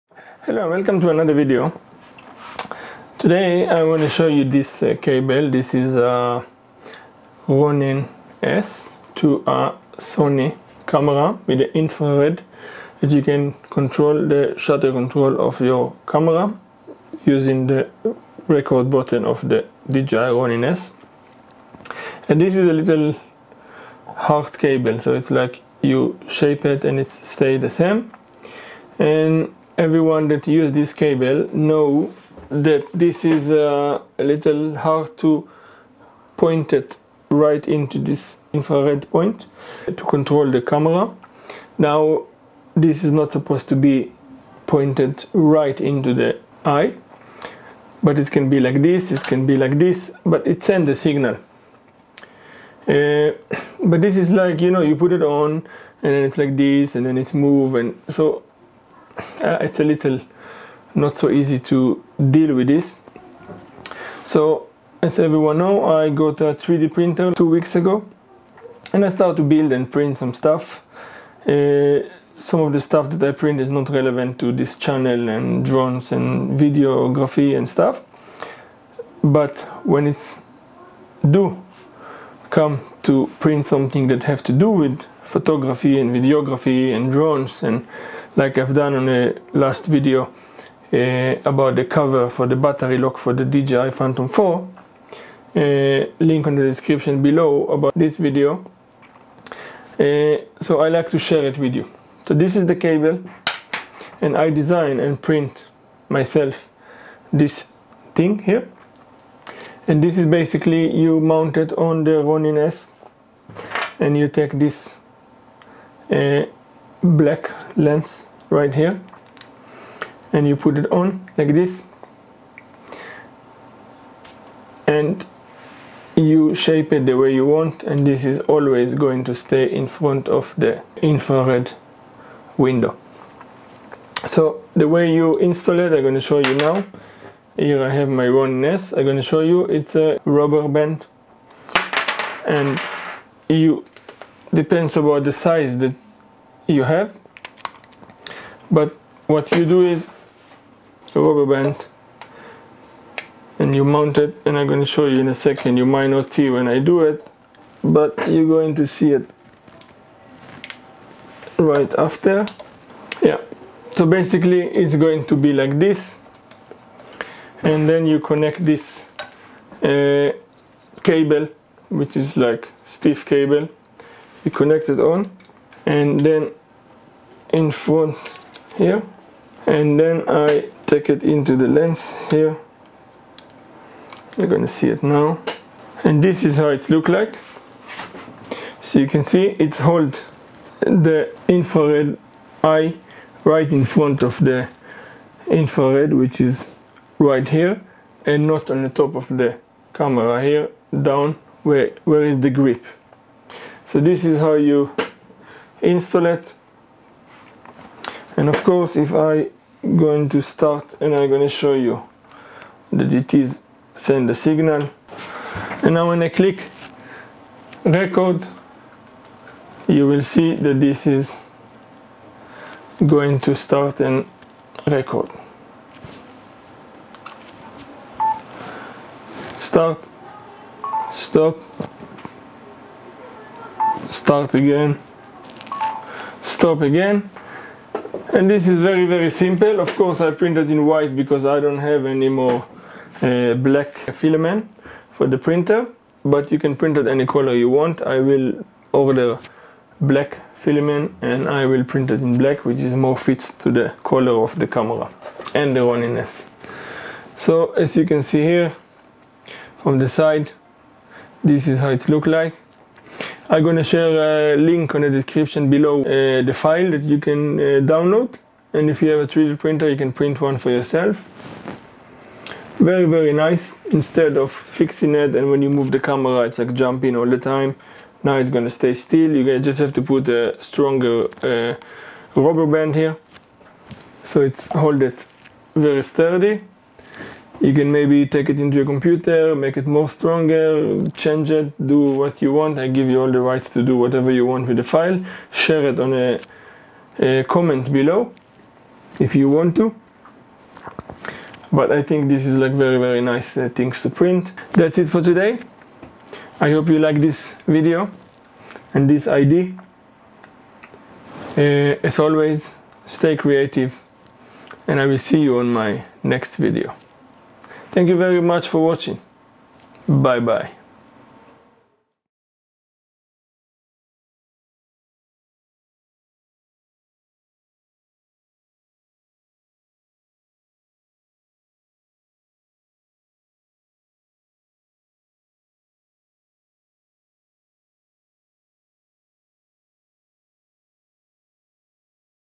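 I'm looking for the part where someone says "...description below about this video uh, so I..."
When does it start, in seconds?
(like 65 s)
96 s.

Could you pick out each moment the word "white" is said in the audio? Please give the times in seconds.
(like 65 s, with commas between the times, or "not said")
240 s.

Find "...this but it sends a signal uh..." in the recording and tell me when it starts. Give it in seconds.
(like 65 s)
49 s.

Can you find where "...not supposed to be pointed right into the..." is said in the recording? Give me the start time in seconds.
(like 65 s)
43 s.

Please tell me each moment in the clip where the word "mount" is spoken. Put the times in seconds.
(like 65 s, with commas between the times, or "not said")
111 s, 153 s.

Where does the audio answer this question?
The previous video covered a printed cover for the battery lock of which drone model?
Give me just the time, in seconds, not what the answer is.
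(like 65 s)
93 s.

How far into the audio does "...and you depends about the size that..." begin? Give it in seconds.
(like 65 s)
142 s.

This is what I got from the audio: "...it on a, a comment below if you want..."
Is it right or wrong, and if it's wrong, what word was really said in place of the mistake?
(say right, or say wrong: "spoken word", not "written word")
right.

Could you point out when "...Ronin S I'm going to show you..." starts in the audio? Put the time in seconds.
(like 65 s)
138 s.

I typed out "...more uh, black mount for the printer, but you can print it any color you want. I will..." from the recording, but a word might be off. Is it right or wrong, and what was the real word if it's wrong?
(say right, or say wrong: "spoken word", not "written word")
wrong: "filament", not "mount".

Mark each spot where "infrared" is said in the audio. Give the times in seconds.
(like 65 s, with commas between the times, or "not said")
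11 s, 38 s, 131 s, 191 s, 195 s.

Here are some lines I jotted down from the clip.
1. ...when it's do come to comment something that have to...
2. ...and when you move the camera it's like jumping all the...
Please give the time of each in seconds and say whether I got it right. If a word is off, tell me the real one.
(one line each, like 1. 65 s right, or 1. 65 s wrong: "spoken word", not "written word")
1. 79 s wrong: "print", not "comment"
2. 275 s right.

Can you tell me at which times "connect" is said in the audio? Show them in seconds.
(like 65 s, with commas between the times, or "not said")
168 s, 174 s.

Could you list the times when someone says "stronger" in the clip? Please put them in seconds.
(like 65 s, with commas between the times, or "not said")
280 s, 290 s.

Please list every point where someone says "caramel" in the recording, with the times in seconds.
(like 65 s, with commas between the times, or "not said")
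not said.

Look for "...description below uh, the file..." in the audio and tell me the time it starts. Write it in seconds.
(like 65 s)
265 s.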